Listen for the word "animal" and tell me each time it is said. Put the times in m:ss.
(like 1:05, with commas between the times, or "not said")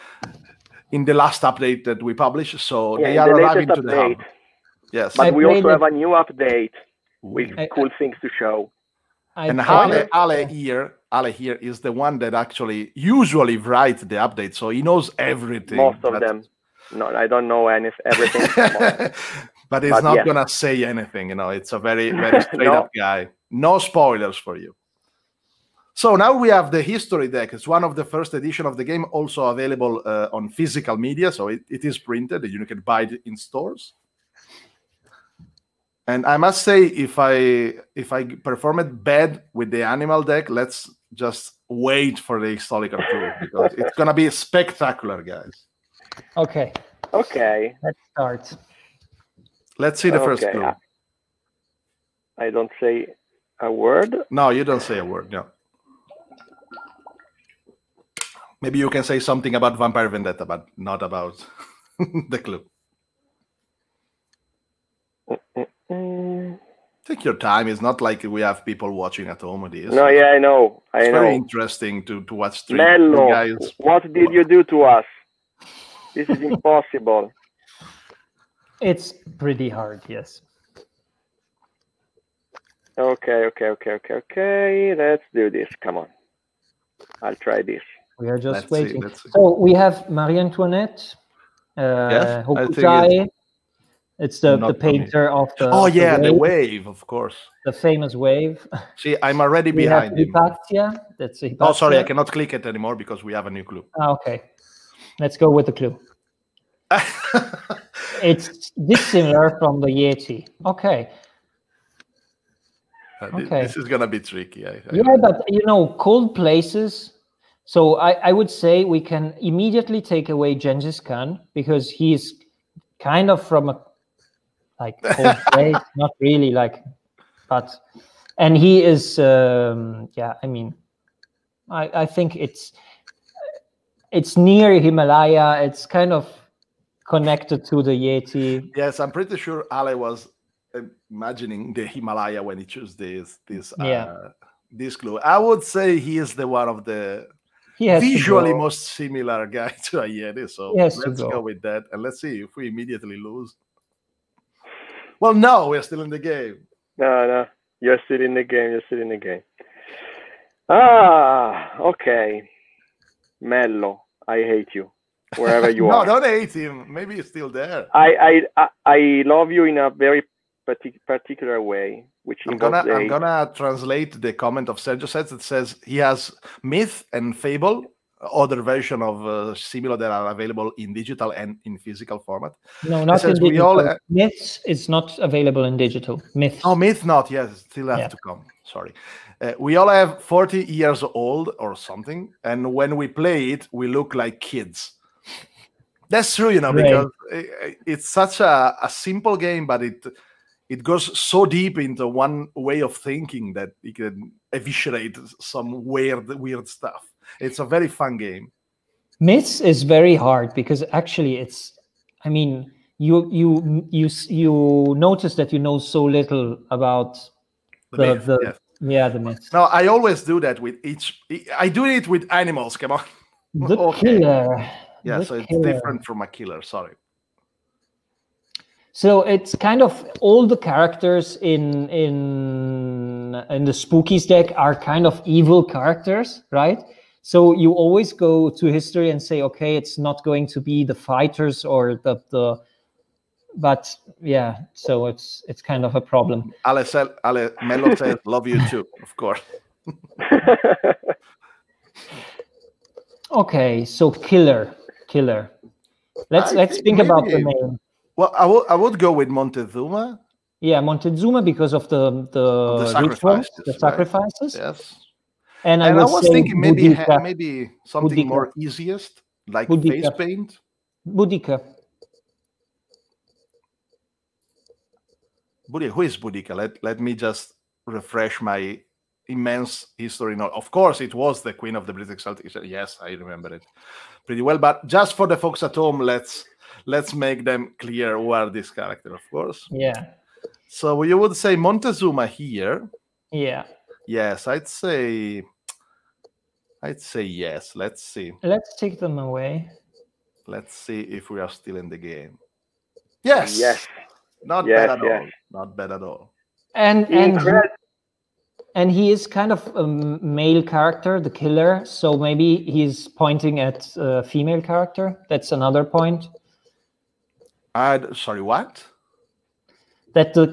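0:39, 3:42.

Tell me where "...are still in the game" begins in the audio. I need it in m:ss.
5:01.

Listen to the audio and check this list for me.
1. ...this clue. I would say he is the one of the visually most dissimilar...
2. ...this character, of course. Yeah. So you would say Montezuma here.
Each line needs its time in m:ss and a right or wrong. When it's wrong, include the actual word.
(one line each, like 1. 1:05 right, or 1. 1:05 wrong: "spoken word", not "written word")
1. 2:24 wrong: "similar", not "dissimilar"
2. 4:48 right.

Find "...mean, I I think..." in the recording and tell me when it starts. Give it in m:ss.
2:10.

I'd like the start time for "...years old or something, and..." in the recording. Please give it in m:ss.
3:10.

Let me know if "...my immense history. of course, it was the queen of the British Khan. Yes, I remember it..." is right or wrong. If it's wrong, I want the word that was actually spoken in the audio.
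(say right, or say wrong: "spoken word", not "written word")
wrong: "Celtic", not "Khan".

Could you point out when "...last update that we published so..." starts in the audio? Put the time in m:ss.
0:01.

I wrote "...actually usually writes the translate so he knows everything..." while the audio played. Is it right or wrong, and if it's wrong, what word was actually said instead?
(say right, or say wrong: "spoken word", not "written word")
wrong: "update", not "translate".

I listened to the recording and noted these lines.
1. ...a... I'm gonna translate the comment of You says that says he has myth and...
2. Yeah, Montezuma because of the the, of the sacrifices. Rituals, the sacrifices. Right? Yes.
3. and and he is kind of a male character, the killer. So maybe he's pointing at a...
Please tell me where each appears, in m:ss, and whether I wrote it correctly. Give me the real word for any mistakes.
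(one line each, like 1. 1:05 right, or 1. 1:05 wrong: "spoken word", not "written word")
1. 2:52 wrong: "Sergio", not "You"
2. 4:20 right
3. 5:07 right.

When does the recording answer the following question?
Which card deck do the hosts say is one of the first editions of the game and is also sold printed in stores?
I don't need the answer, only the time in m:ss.
0:26.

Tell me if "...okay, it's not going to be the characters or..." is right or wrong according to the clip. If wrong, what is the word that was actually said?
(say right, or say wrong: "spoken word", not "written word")
wrong: "fighters", not "characters".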